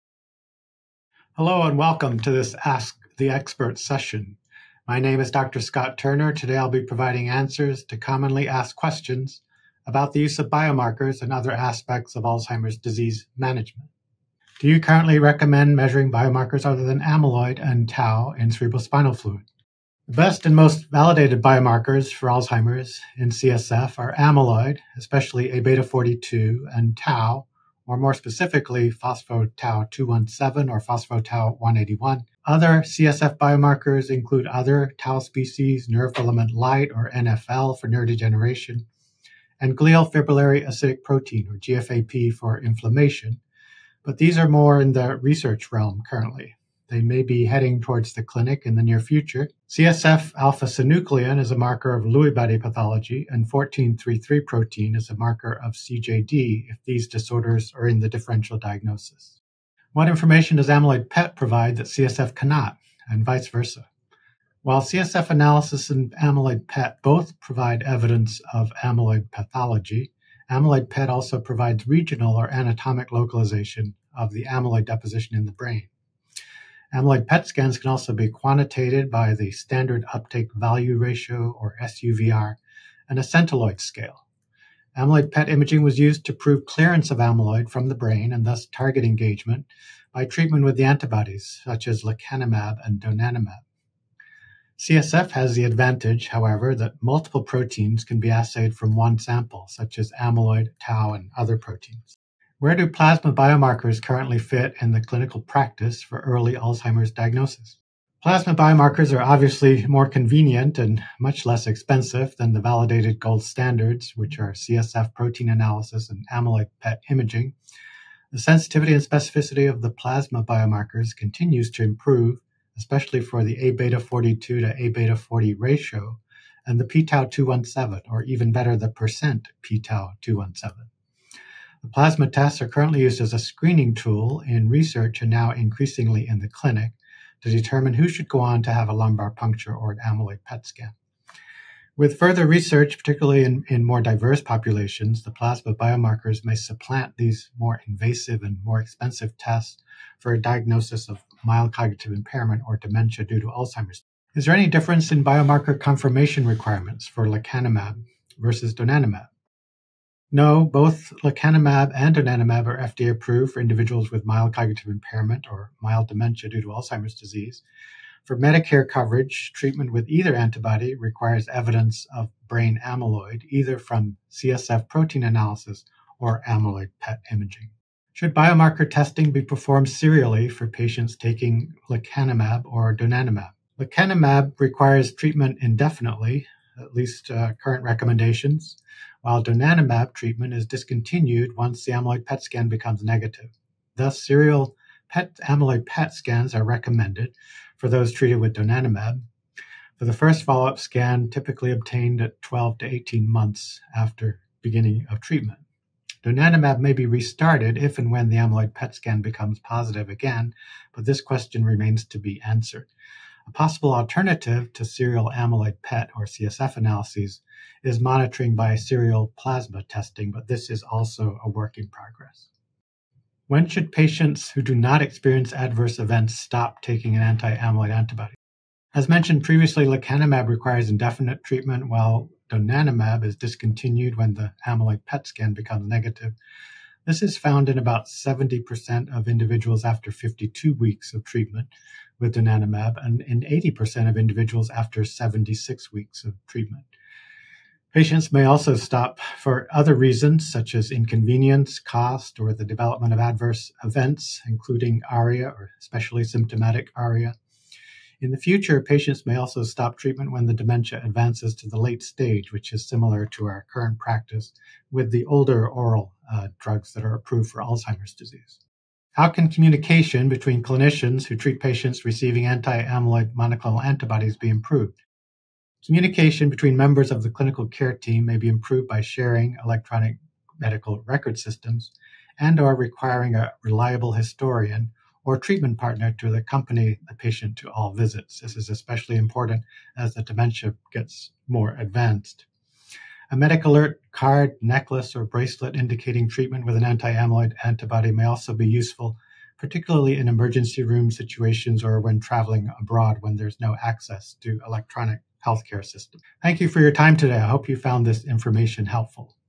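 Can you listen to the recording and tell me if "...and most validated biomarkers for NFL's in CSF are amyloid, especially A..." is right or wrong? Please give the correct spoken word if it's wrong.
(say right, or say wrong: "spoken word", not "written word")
wrong: "Alzheimer", not "NFL".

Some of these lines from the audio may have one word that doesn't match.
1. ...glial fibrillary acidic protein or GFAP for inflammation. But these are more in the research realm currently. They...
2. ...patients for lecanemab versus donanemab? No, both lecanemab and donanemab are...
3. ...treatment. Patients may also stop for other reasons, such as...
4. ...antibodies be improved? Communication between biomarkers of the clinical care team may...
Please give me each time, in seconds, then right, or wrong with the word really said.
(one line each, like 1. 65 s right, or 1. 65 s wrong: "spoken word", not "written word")
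1. 39 s right
2. 156 s wrong: "requirements", not "patients"
3. 246 s right
4. 273 s wrong: "members", not "biomarkers".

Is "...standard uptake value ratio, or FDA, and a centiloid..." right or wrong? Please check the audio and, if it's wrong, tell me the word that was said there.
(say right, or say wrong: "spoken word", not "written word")
wrong: "SUVR", not "FDA".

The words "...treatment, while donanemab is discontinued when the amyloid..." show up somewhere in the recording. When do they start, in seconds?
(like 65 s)
231 s.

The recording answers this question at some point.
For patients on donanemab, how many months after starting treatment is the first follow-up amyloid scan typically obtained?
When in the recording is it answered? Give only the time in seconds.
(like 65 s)
202 s.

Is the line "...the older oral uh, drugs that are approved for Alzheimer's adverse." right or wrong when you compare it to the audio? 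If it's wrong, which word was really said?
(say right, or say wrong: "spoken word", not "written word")
wrong: "disease", not "adverse".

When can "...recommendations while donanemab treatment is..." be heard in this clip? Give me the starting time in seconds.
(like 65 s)
187 s.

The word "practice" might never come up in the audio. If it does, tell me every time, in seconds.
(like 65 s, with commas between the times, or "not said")
105 s, 263 s.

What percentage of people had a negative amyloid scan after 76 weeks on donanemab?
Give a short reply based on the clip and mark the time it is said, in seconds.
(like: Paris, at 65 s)
80%, at 243 s.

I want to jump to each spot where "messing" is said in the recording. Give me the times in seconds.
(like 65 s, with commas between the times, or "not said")
not said.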